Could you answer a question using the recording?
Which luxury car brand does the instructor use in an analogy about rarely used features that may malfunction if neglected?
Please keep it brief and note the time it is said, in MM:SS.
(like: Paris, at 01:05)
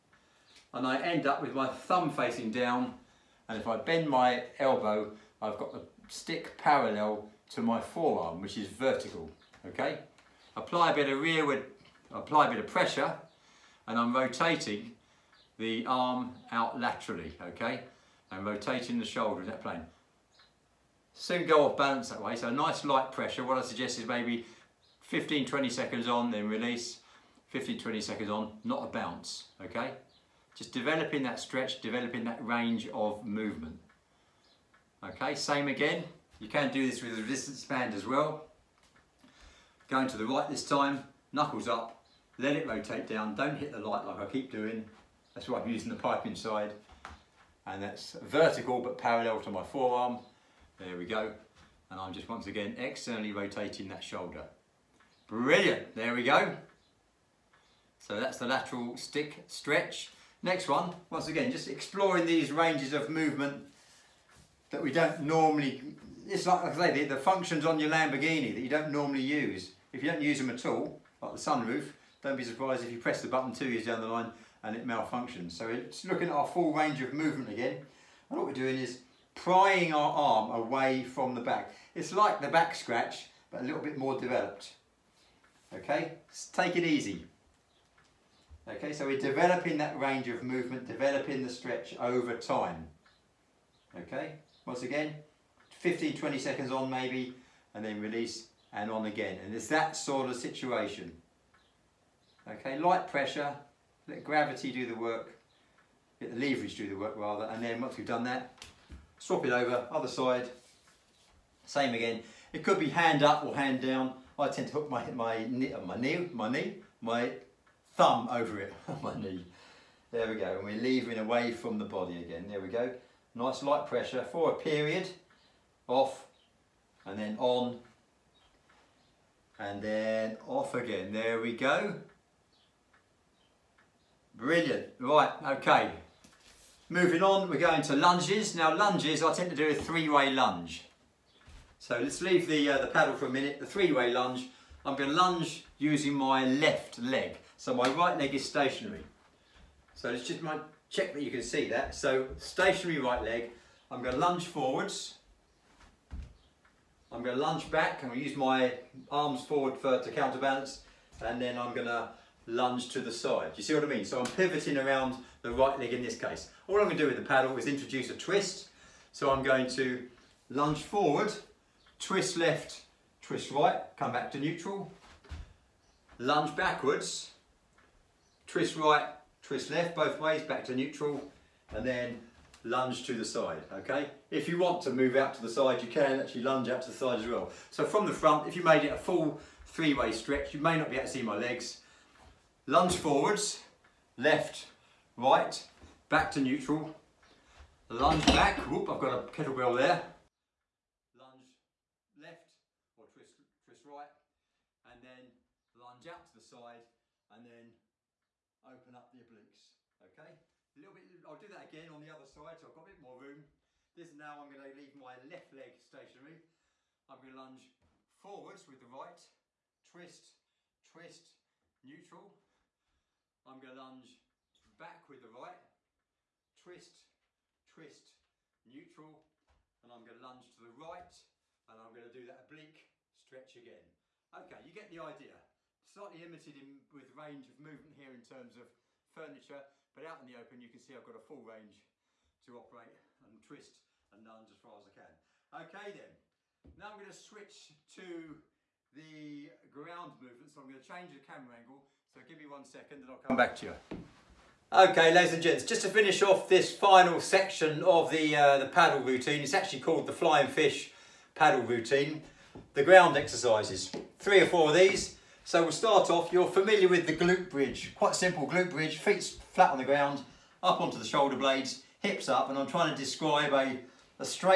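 Lamborghini, at 01:07.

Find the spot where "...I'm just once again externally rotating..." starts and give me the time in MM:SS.
00:51.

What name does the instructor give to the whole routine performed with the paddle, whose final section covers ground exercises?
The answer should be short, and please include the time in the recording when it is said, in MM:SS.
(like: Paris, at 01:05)
flying fish paddle routine, at 04:20.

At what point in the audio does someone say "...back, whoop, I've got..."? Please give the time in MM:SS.
03:18.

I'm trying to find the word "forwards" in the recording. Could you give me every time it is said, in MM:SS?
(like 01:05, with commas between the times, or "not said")
02:34, 02:39, 02:50, 03:12, 03:38.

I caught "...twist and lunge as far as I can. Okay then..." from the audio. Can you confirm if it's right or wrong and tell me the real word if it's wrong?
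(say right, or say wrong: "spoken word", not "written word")
right.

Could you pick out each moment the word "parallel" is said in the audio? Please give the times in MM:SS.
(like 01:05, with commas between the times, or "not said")
00:06, 00:48.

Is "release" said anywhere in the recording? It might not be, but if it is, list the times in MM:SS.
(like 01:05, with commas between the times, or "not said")
00:26, 01:37.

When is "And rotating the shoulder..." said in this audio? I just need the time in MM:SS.
00:18.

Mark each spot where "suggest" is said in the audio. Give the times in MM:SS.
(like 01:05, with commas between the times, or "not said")
00:23.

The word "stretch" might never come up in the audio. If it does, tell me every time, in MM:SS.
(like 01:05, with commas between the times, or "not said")
00:31, 00:59, 01:31, 03:10, 03:53.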